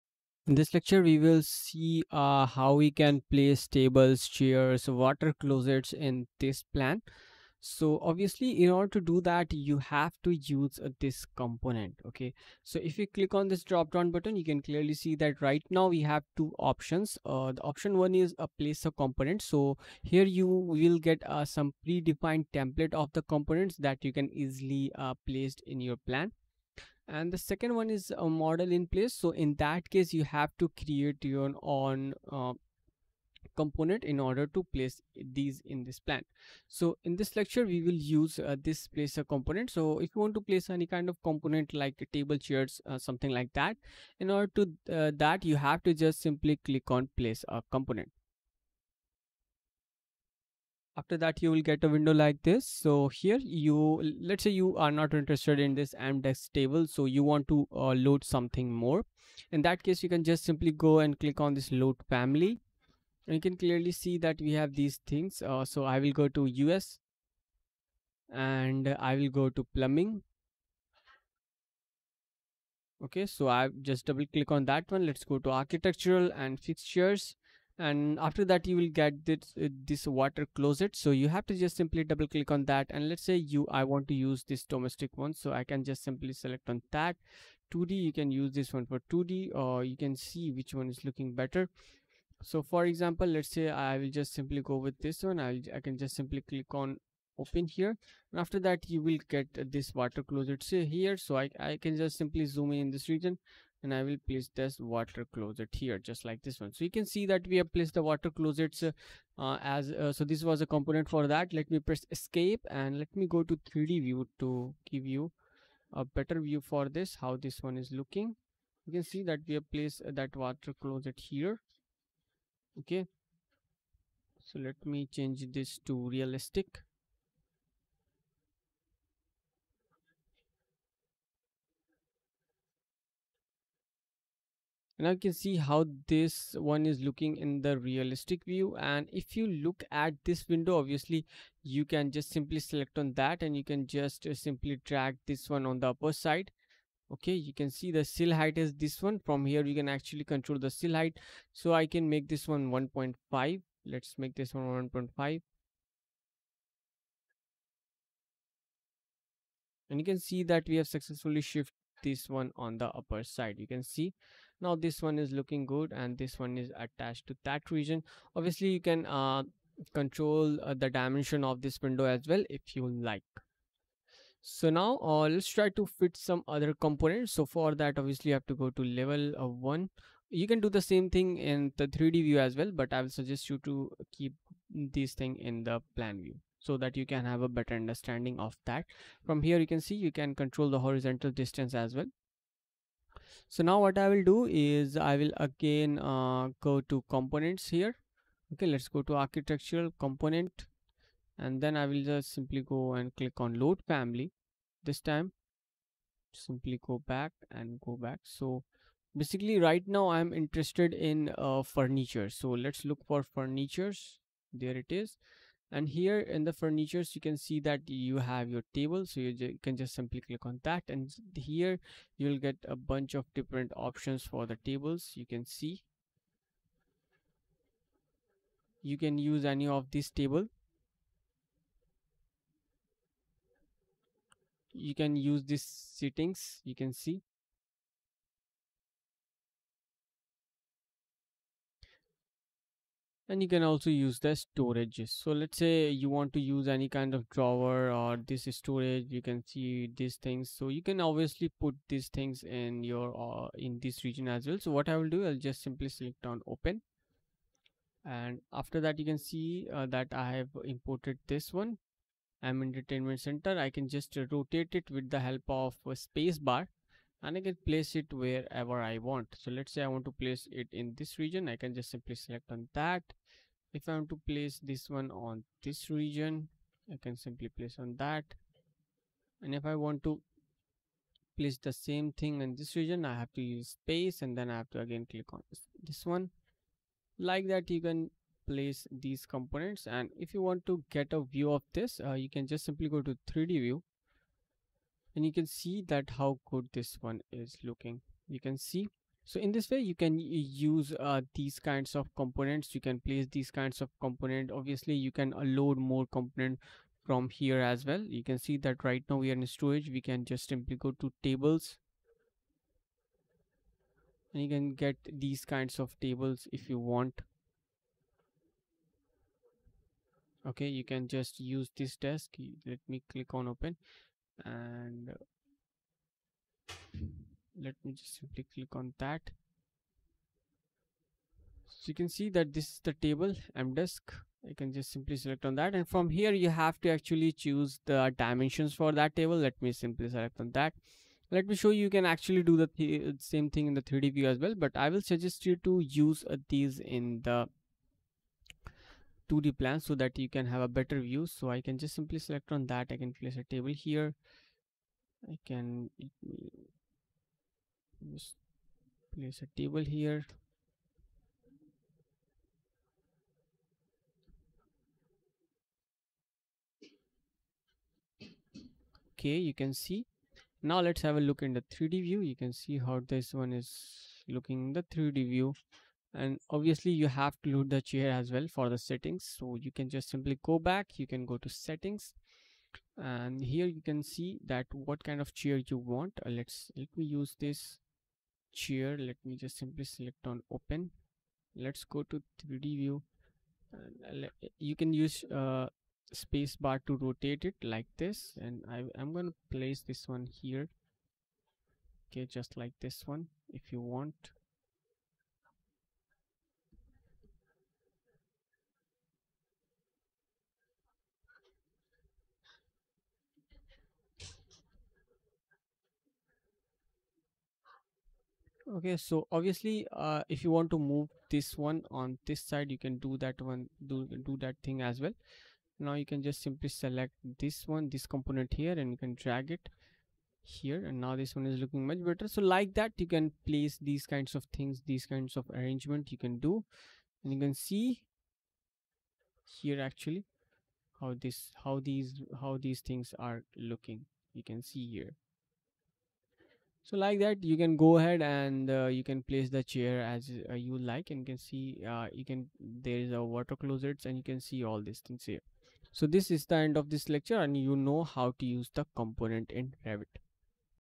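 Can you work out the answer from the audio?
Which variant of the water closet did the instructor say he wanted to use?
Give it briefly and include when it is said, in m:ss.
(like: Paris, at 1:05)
Domestic, at 1:24.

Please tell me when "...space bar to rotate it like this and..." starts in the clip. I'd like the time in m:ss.
6:36.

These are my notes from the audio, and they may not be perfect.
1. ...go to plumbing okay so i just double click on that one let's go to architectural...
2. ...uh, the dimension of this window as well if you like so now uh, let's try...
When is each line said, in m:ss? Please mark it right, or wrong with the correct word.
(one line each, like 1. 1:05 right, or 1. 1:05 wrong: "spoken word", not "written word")
1. 1:09 right
2. 2:50 right.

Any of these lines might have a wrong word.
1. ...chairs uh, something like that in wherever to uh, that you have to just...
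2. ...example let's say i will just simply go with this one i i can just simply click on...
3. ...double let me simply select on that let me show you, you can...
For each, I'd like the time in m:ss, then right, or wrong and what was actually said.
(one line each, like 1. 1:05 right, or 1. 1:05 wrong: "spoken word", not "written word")
1. 0:42 wrong: "order", not "wherever"
2. 1:32 right
3. 5:39 wrong: "table", not "double".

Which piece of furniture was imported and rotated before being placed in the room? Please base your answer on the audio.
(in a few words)
Entertainment center.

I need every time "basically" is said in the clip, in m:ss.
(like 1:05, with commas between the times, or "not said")
3:29.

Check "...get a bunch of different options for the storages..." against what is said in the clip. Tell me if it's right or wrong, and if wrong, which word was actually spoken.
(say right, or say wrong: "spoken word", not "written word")
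wrong: "tables", not "storages".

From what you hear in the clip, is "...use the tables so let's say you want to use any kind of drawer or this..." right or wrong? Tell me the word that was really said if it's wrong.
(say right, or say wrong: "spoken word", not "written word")
wrong: "storages", not "tables".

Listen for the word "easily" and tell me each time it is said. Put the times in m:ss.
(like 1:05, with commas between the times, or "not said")
0:24.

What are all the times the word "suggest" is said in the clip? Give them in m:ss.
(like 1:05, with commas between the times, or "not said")
3:03, 5:45.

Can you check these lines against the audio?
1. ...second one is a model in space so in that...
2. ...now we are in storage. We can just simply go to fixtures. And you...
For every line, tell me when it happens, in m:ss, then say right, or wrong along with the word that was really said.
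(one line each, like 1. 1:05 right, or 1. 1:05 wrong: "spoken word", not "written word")
1. 0:27 wrong: "place", not "space"
2. 5:09 wrong: "tables", not "fixtures".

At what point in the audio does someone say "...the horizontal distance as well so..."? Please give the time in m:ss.
3:10.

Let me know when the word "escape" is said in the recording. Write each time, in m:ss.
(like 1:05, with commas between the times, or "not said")
1:52.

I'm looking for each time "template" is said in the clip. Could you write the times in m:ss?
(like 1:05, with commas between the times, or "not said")
0:22.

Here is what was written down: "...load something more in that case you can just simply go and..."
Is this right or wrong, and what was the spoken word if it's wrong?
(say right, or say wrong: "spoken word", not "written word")
right.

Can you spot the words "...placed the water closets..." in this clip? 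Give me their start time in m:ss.
1:47.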